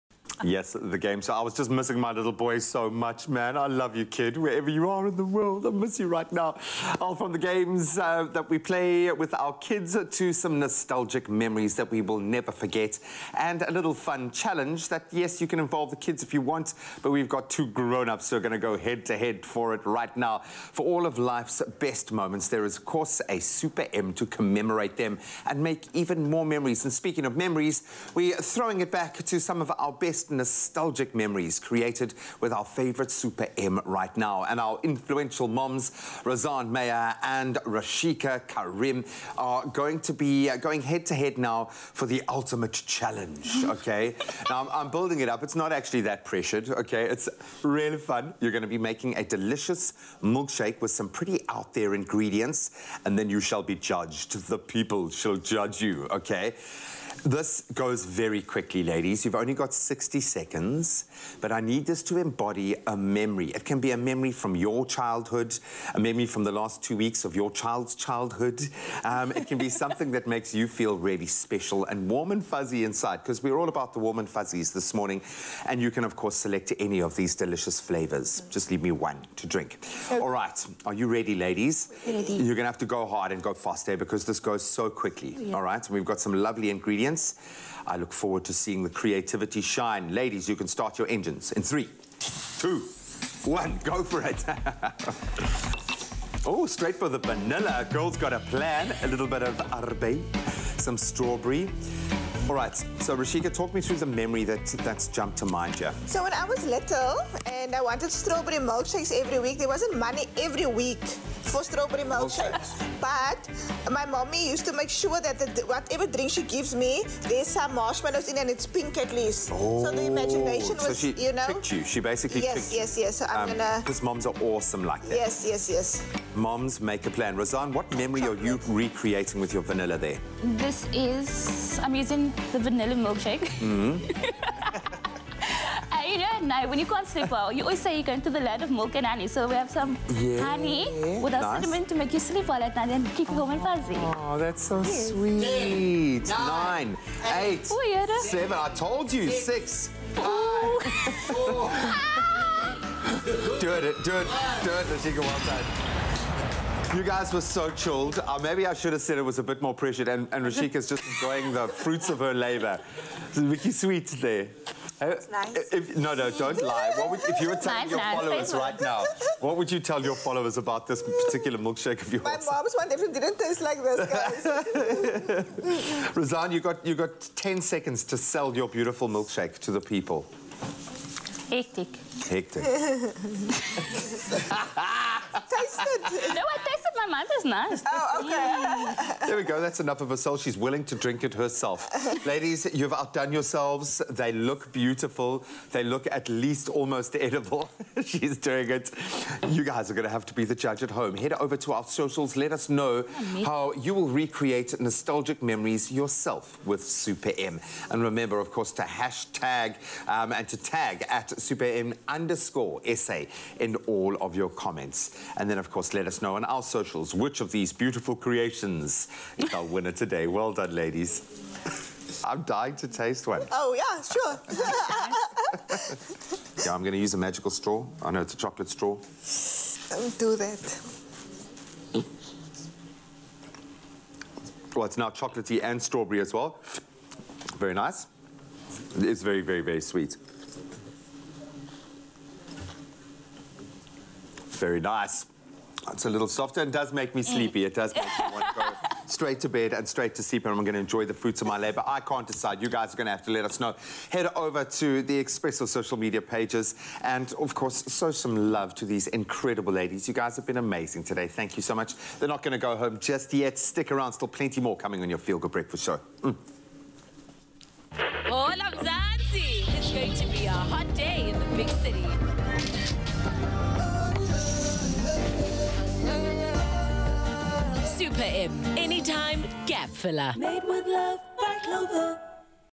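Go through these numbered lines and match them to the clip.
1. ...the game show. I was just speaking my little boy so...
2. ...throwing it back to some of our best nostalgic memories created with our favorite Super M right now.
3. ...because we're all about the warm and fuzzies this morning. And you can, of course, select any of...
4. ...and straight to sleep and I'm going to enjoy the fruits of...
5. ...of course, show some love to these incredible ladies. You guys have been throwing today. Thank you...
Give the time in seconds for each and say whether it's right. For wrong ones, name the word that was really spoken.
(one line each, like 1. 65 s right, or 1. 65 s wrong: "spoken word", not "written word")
1. 0 s wrong: "missing", not "speaking"
2. 28 s right
3. 73 s right
4. 249 s right
5. 257 s wrong: "amazing", not "throwing".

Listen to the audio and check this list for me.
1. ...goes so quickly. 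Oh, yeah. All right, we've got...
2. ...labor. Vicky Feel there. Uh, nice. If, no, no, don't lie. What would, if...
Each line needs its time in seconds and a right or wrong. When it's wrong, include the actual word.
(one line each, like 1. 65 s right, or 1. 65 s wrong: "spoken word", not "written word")
1. 84 s right
2. 162 s wrong: "Sweet", not "Feel".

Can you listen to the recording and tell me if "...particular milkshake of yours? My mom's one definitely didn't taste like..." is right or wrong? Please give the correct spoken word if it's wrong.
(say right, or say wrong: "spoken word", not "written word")
right.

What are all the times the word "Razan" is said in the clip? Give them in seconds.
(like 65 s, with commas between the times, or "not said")
36 s, 127 s, 176 s.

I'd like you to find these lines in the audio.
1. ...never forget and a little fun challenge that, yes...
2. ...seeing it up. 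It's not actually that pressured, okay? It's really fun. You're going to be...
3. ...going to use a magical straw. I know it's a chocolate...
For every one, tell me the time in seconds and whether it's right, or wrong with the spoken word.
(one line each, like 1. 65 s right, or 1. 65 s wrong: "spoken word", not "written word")
1. 12 s right
2. 44 s wrong: "building", not "seeing"
3. 226 s right.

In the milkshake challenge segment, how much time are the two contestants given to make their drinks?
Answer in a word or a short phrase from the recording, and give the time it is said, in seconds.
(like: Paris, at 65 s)
60 seconds, at 59 s.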